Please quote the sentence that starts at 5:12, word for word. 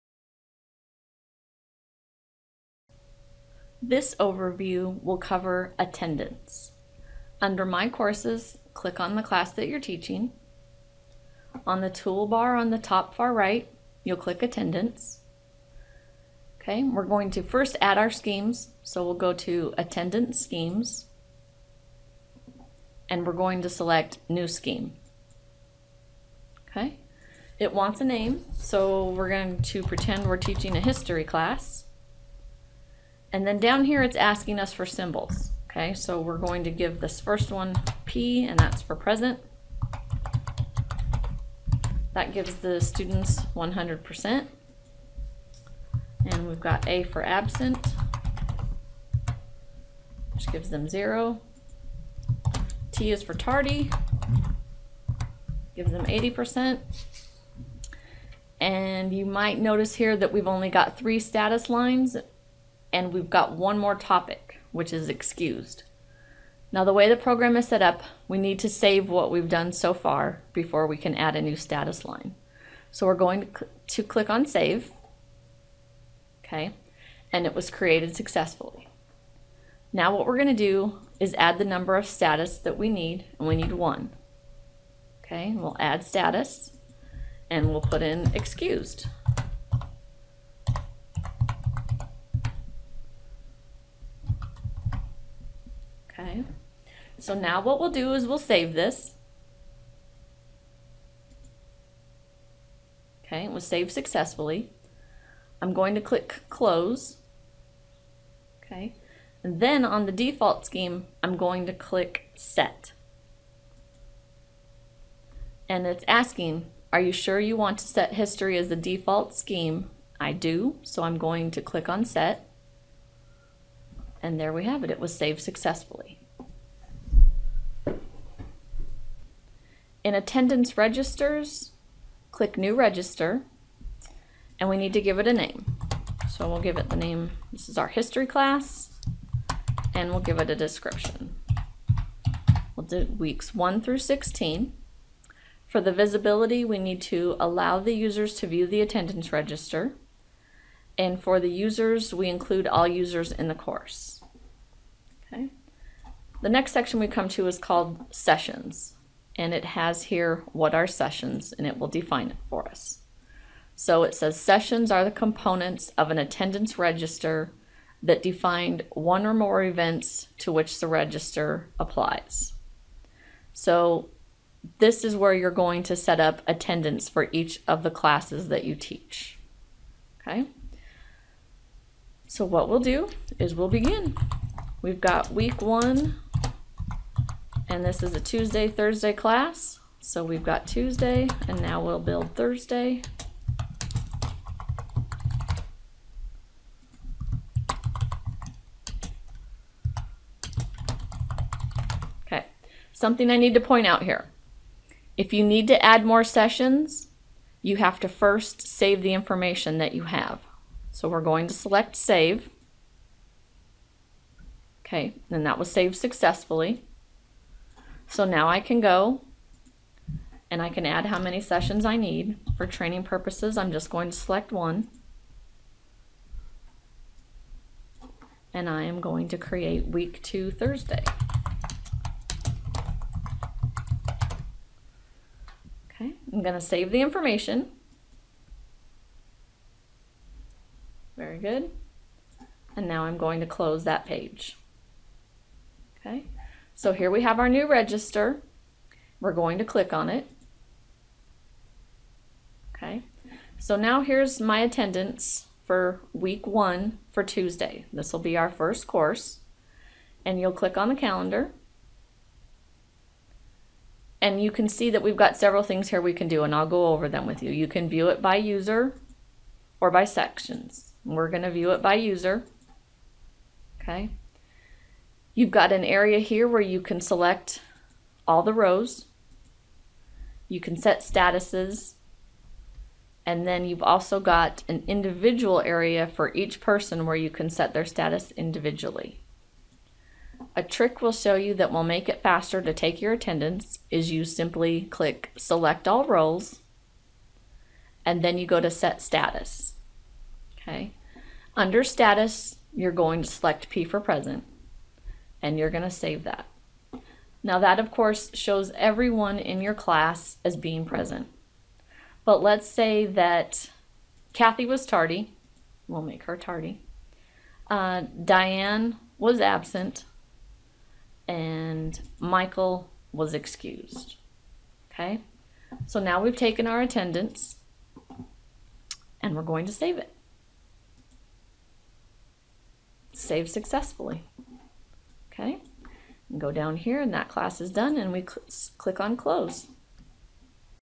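But let's say that Kathy was tardy.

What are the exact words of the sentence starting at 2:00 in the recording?
I do, so I'm going to click on set.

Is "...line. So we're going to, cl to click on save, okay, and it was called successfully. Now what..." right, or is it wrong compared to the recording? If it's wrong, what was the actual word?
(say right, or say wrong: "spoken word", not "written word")
wrong: "created", not "called".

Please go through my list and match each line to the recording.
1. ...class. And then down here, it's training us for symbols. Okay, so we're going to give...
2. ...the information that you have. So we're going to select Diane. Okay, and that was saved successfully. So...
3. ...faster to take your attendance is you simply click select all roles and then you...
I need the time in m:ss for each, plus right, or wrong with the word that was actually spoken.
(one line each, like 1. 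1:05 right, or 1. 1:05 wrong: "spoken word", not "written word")
1. 0:31 wrong: "asking", not "training"
2. 3:29 wrong: "Save", not "Diane"
3. 4:52 right.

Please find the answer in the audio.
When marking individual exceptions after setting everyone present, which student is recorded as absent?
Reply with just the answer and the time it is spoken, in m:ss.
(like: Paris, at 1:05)
Diane, at 5:18.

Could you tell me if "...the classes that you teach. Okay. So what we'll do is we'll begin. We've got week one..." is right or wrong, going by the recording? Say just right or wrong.
right.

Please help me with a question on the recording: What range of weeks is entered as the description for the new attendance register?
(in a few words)
weeks 1 through 16.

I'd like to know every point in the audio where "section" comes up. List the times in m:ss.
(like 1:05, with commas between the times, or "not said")
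2:36, 4:30.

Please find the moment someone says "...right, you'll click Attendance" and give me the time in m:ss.
0:13.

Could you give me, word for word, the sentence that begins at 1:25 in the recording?
Okay, and we'll add status, and we'll put in excused.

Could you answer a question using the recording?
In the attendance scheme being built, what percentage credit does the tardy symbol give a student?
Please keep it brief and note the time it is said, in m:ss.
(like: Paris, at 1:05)
80%, at 0:56.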